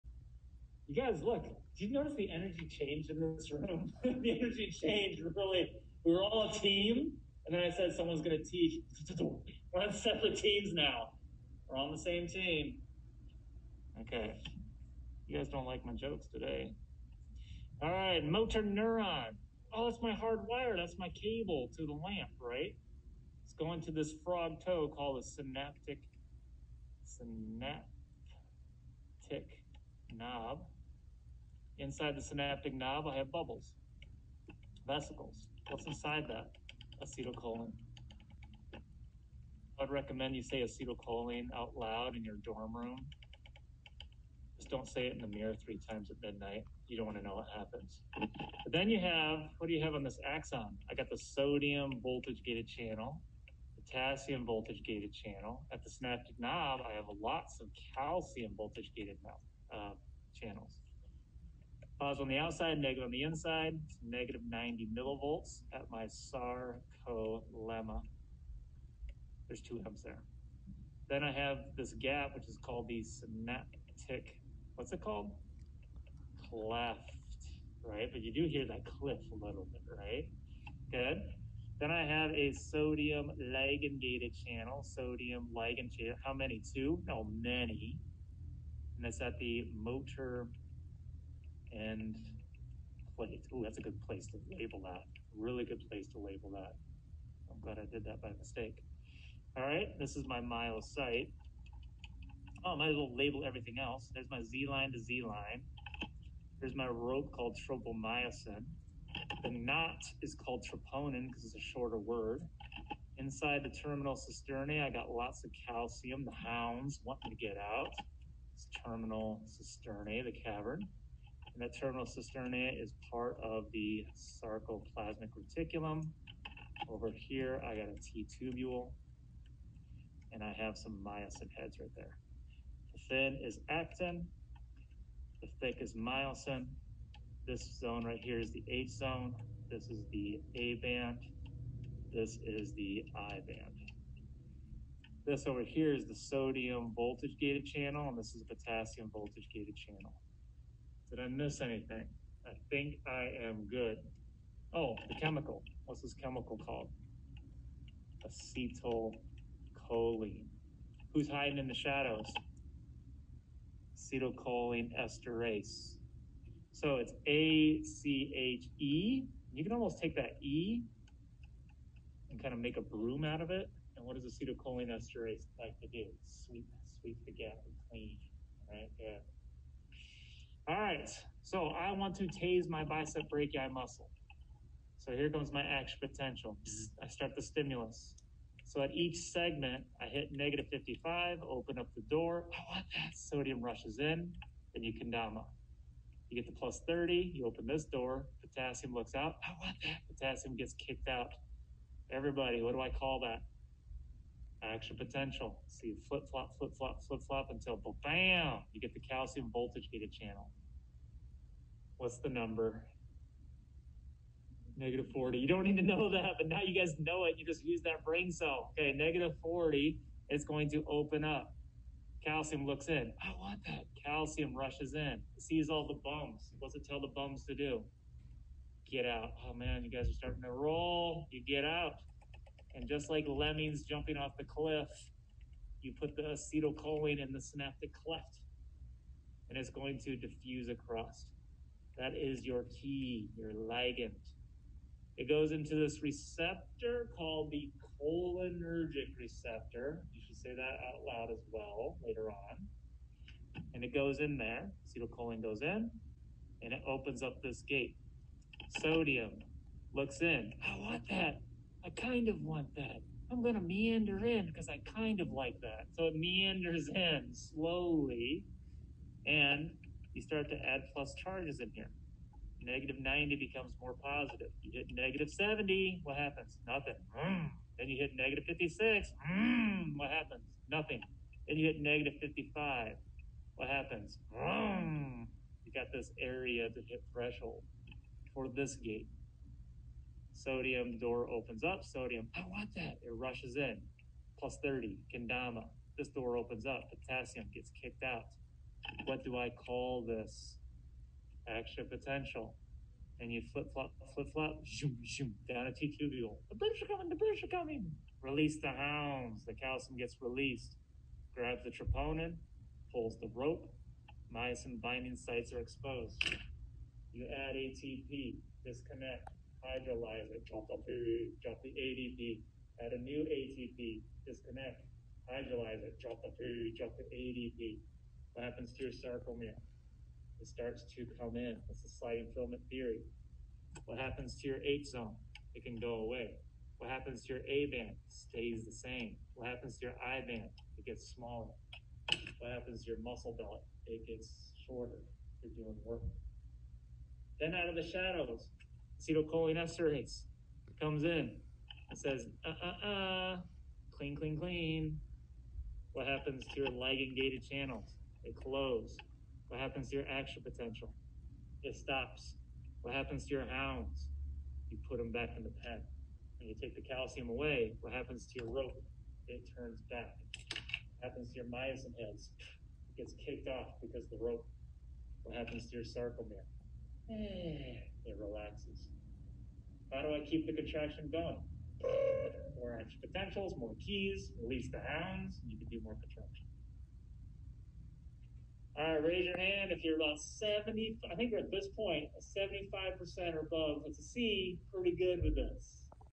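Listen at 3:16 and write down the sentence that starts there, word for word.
You get to plus 30, you open this door, potassium looks out.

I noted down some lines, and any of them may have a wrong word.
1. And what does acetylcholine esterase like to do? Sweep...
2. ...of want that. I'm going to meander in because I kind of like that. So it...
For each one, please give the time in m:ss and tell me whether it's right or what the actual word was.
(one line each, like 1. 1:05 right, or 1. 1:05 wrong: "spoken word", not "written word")
1. 2:53 right
2. 4:22 right.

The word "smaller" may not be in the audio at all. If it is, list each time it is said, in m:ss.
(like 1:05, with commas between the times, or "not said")
5:41.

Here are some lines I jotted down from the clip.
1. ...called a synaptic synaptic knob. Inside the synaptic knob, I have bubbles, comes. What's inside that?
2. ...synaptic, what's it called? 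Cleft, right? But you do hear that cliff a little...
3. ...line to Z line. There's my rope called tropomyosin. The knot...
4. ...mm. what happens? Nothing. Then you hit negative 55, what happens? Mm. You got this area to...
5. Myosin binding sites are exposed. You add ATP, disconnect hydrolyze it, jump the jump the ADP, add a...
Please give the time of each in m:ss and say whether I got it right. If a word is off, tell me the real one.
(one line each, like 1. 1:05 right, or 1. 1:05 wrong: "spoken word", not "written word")
1. 0:24 wrong: "vesicles", not "comes"
2. 1:13 right
3. 1:44 right
4. 4:39 right
5. 5:14 right.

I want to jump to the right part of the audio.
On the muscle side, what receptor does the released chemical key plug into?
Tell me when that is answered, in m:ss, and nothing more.
4:08.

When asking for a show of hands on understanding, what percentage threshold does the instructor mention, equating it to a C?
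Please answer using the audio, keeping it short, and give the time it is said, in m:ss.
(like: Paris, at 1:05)
75%, at 6:32.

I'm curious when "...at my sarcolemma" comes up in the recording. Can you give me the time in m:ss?
1:05.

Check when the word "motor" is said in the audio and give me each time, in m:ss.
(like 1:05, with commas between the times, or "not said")
0:18, 1:29.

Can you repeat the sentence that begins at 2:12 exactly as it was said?
The thin is actin, the thick is myosin.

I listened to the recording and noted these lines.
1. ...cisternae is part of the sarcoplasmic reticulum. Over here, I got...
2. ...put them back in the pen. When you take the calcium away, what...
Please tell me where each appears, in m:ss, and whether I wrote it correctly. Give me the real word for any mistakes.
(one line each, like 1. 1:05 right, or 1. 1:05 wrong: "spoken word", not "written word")
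1. 2:02 right
2. 6:04 right.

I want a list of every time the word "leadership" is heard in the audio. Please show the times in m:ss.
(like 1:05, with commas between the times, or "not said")
not said.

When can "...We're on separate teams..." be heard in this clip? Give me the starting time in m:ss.
0:09.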